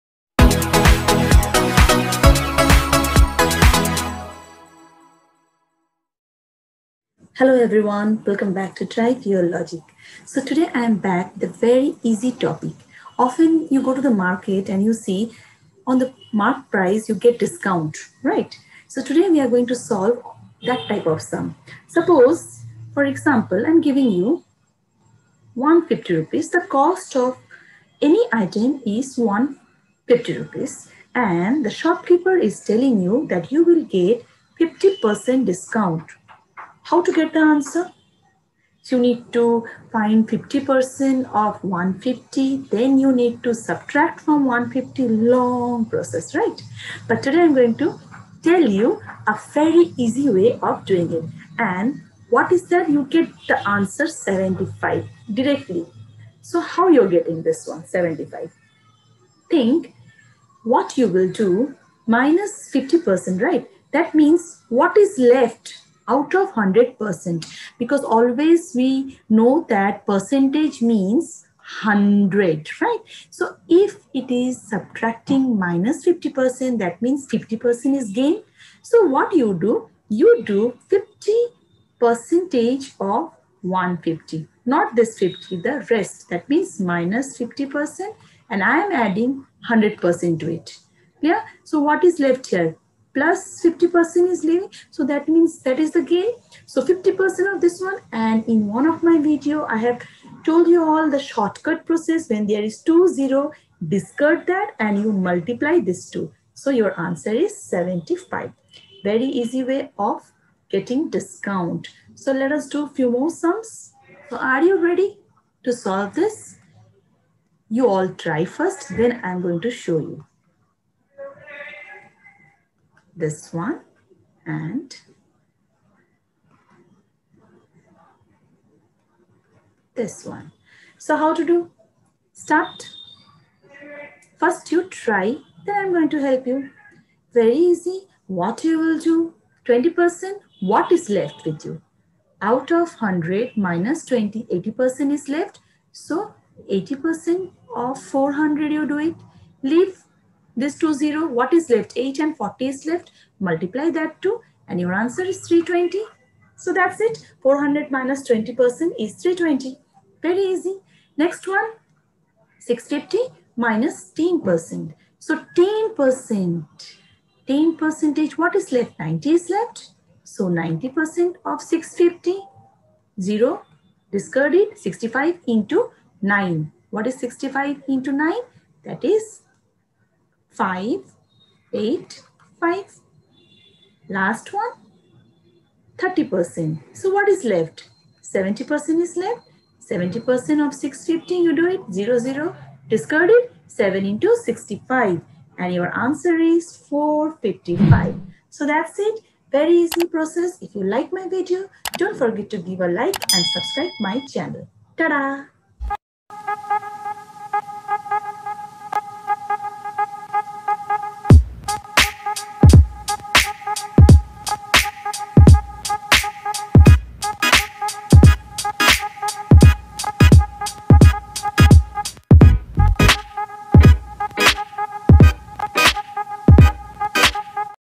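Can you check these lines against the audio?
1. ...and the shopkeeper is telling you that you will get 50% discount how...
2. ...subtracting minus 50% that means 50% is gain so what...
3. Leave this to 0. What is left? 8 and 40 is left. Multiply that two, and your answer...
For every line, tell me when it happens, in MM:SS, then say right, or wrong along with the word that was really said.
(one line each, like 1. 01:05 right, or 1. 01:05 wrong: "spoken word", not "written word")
1. 00:31 right
2. 01:14 right
3. 02:29 right.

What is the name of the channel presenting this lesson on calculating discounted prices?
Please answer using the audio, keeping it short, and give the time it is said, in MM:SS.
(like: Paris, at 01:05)
Drive Your Logic, at 00:08.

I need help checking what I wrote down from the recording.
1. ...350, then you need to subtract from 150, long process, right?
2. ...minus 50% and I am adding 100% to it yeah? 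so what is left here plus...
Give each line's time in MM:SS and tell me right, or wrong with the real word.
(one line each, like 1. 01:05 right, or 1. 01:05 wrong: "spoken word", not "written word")
1. 00:41 wrong: "150", not "350"
2. 01:26 right.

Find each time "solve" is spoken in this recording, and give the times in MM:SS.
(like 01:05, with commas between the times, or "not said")
00:19, 01:55.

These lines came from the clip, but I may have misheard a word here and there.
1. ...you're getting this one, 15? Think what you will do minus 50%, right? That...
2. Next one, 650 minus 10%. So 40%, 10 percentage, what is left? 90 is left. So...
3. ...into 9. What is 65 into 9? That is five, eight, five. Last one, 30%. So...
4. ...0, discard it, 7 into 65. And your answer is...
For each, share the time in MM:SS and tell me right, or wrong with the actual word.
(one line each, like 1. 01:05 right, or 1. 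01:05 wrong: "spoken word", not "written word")
1. 00:56 wrong: "75", not "15"
2. 02:41 wrong: "10", not "40"
3. 02:55 right
4. 03:12 right.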